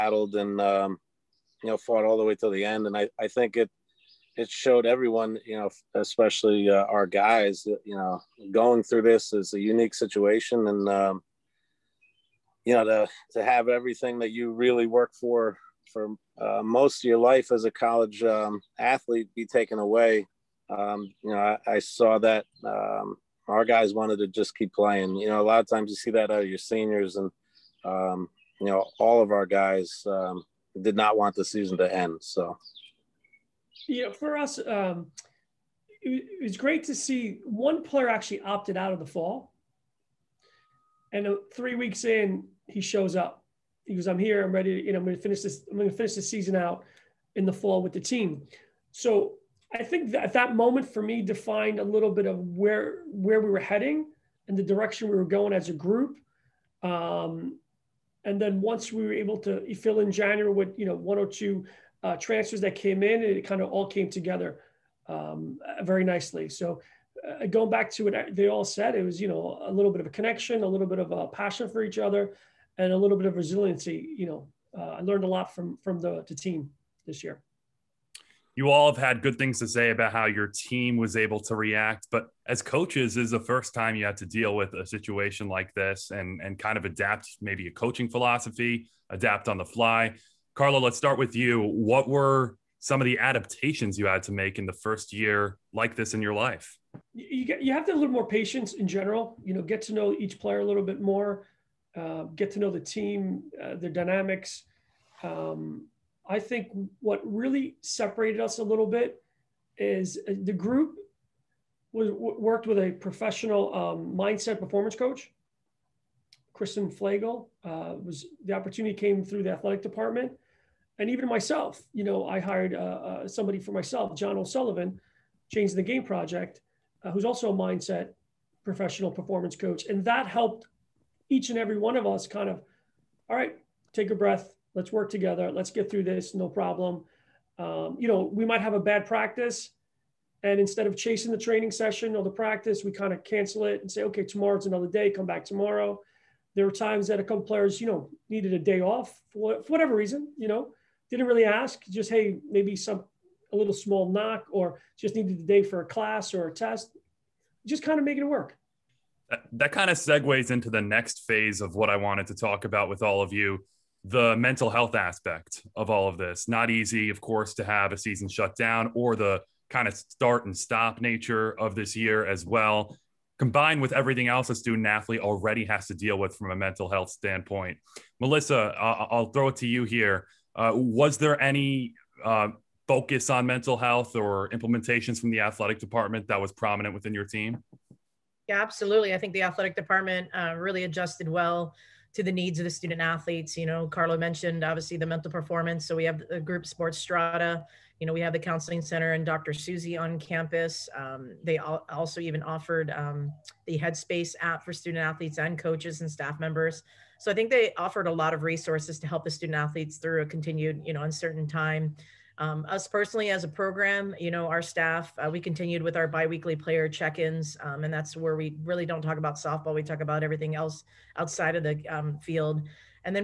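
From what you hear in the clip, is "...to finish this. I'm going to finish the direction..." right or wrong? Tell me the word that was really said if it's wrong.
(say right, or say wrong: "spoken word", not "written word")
wrong: "season", not "direction".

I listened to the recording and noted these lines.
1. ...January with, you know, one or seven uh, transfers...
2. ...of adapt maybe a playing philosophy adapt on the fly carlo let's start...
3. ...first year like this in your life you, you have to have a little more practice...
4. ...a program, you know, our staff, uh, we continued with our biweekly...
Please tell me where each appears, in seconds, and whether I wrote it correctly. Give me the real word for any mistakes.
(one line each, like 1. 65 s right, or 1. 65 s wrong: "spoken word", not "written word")
1. 60 s wrong: "two", not "seven"
2. 86 s wrong: "coaching", not "playing"
3. 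94 s wrong: "patience", not "practice"
4. 213 s right.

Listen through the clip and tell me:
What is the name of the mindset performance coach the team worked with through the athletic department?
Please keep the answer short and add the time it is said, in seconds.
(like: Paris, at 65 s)
Kristen Flagel, at 116 s.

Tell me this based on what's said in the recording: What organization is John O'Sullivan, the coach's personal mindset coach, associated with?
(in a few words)
Change the Game Project.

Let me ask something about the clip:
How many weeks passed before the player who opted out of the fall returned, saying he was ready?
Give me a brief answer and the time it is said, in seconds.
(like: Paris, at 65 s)
3, at 41 s.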